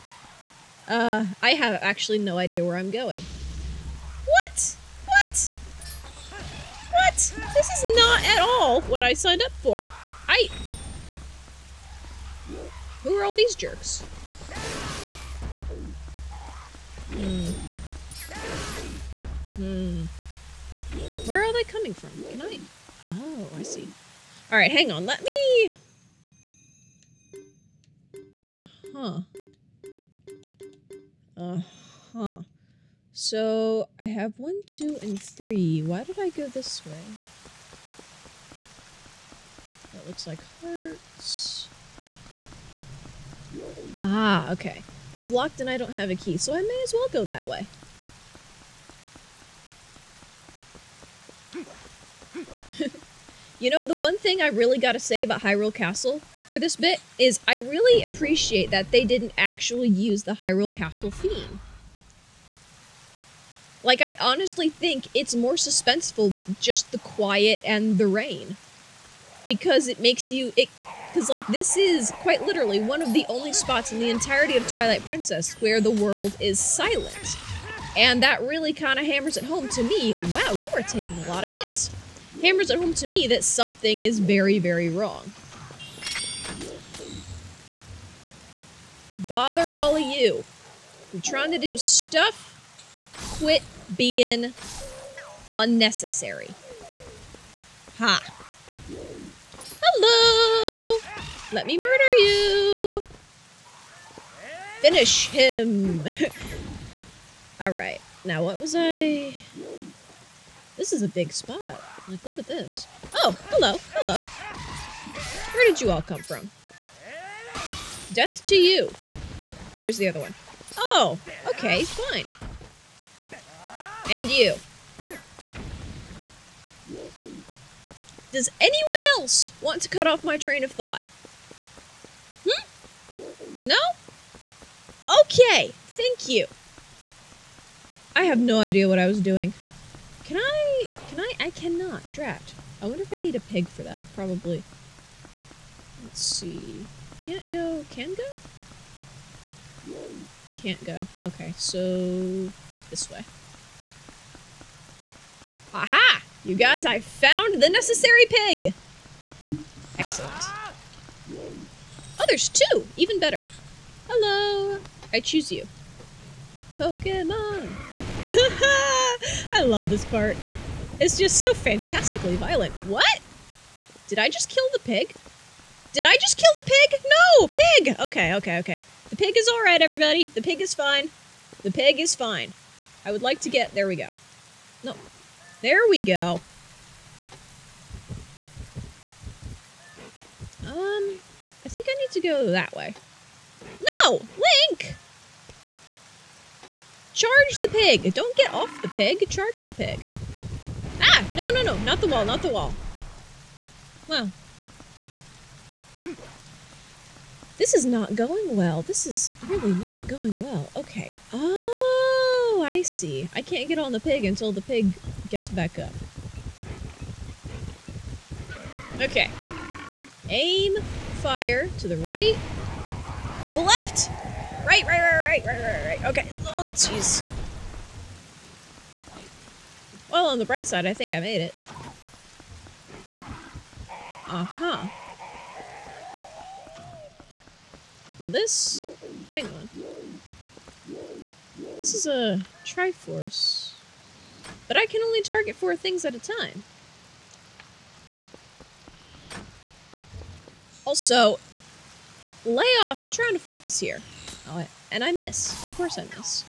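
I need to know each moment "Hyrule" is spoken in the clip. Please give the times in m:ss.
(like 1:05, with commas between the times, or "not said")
0:55, 1:00.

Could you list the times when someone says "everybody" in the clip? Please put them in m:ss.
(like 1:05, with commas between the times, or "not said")
2:59.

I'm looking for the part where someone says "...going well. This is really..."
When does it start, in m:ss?
3:28.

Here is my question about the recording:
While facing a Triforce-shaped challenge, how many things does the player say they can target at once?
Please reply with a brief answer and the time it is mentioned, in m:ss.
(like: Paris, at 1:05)
4, at 4:05.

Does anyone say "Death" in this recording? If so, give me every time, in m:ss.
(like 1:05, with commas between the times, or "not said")
1:58.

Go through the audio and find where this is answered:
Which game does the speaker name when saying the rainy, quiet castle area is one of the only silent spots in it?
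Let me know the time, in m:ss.
1:14.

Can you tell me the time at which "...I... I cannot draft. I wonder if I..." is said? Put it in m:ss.
2:21.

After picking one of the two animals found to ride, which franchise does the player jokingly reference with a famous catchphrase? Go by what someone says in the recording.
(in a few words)
Pokemon.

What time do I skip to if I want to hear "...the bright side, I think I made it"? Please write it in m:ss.
3:50.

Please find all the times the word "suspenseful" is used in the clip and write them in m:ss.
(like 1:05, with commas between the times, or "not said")
1:05.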